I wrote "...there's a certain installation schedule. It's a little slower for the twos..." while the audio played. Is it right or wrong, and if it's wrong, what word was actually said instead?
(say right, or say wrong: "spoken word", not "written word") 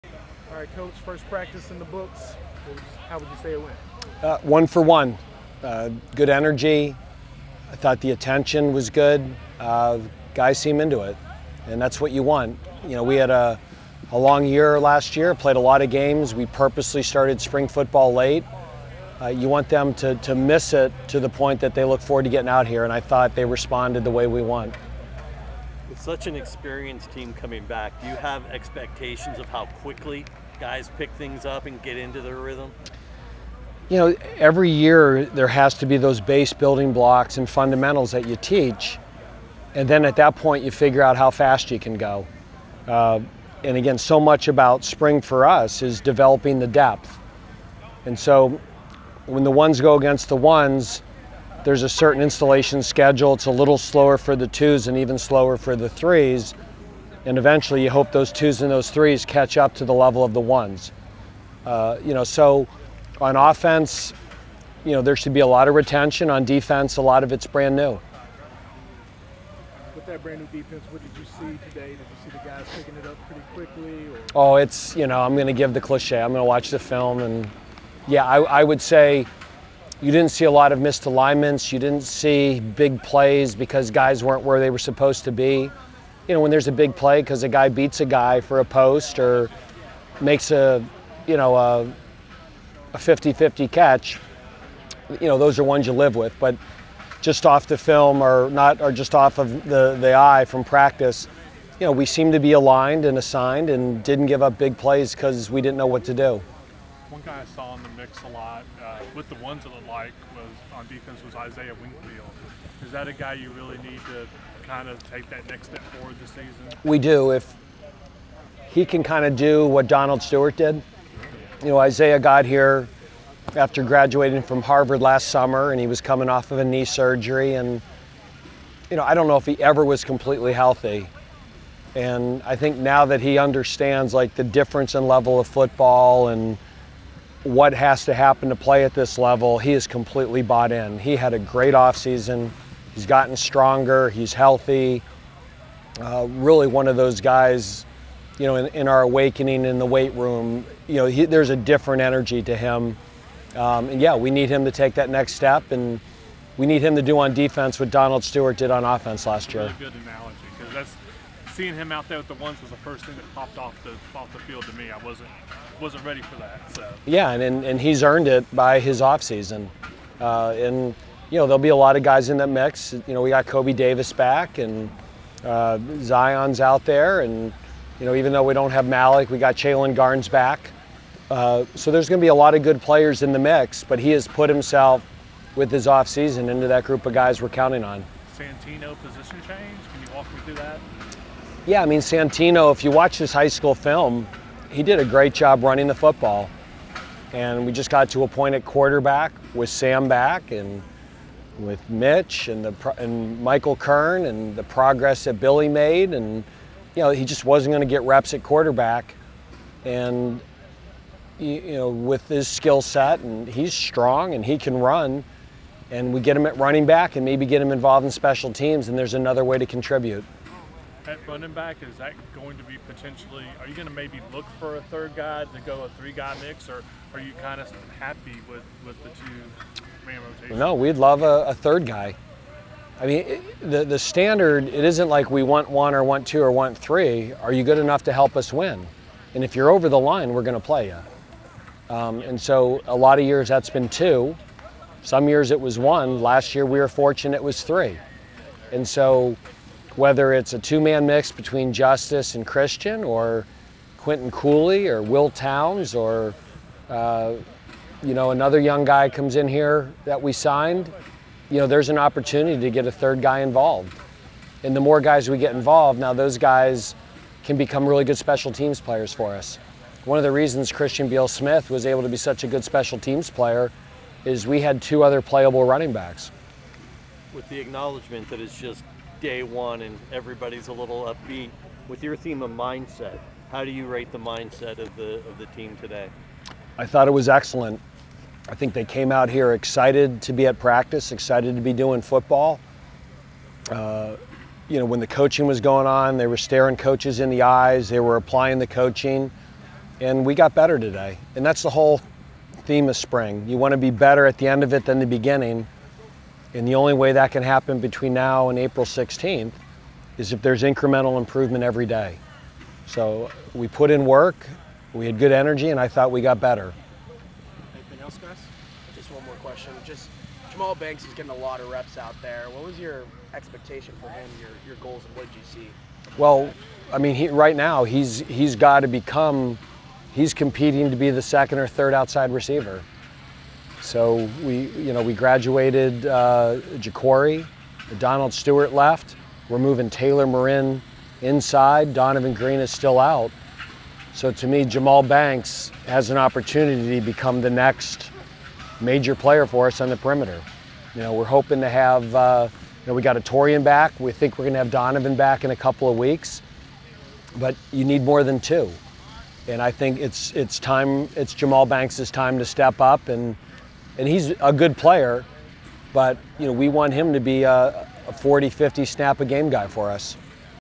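right.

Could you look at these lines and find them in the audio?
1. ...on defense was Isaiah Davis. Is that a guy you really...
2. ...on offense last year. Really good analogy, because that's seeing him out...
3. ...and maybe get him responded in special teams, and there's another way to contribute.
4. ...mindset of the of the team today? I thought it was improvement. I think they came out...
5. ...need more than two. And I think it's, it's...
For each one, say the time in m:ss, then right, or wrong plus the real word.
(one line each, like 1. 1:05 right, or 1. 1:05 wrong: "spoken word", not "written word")
1. 1:50 wrong: "Wingfield", not "Davis"
2. 2:38 right
3. 3:37 wrong: "involved", not "responded"
4. 4:44 wrong: "excellent", not "improvement"
5. 5:57 right.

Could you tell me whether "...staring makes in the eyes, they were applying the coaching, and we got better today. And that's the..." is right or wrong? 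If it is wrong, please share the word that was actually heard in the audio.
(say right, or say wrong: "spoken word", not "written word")
wrong: "coaches", not "makes".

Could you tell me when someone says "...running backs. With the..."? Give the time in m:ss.
4:35.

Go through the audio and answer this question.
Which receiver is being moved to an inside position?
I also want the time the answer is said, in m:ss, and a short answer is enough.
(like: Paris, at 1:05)
Taylor Morin, at 5:39.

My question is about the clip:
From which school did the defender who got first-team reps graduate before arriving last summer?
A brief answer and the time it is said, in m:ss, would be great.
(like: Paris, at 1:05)
Harvard, at 2:04.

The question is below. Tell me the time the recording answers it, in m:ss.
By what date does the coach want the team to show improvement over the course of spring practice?
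5:08.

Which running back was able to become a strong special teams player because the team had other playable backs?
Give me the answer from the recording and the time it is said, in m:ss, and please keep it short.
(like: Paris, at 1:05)
Christian Beal Smith, at 4:30.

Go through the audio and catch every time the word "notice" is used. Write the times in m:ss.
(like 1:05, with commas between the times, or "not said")
not said.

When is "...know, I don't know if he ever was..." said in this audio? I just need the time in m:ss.
2:08.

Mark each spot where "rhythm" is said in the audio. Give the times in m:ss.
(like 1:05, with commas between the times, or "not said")
0:32.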